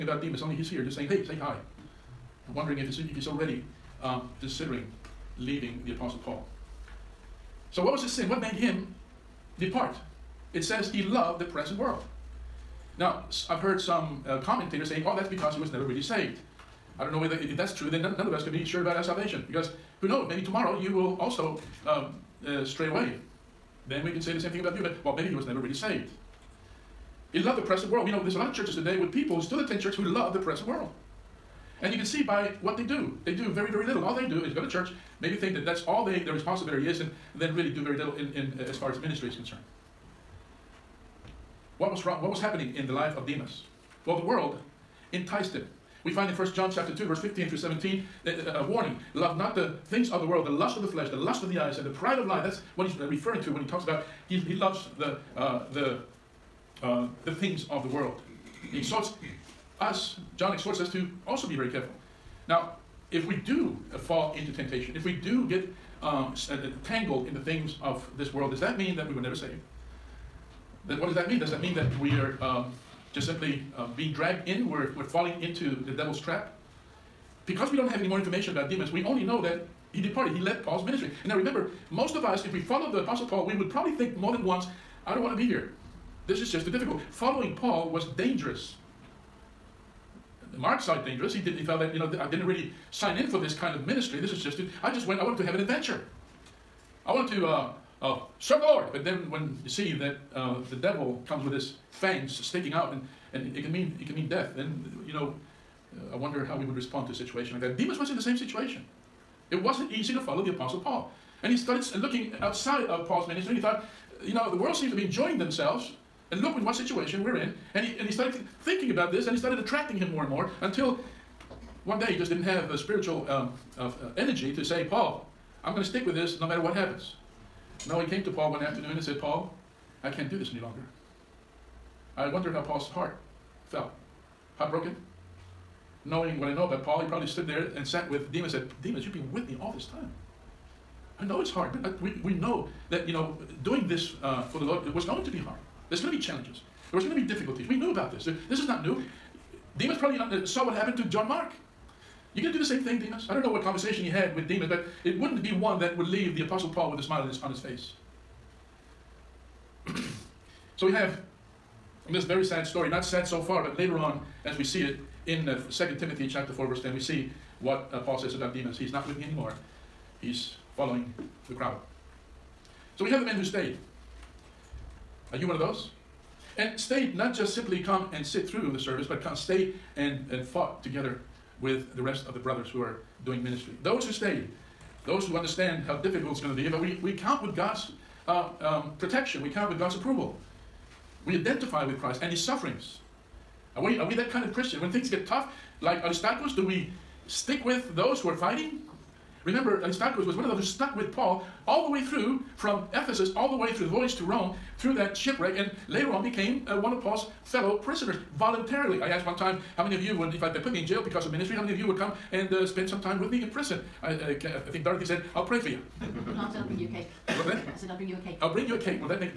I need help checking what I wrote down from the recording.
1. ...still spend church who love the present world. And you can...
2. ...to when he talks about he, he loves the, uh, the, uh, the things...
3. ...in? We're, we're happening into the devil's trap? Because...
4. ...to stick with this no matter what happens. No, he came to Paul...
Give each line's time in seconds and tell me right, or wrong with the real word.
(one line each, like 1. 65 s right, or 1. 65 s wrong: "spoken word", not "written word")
1. 29 s wrong: "attend", not "spend"
2. 53 s right
3. 74 s wrong: "falling", not "happening"
4. 125 s right.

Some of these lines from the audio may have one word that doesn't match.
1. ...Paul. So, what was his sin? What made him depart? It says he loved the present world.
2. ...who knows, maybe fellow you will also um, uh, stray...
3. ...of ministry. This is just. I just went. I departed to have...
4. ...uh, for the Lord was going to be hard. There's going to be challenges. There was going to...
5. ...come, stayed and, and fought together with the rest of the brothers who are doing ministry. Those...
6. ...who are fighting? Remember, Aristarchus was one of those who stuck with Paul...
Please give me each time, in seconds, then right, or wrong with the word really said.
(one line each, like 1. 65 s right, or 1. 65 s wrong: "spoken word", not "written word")
1. 6 s right
2. 20 s wrong: "tomorrow", not "fellow"
3. 93 s wrong: "wanted", not "departed"
4. 144 s right
5. 179 s right
6. 198 s right.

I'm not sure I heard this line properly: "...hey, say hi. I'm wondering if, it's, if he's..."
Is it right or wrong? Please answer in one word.
right.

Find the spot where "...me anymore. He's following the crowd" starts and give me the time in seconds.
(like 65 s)
169 s.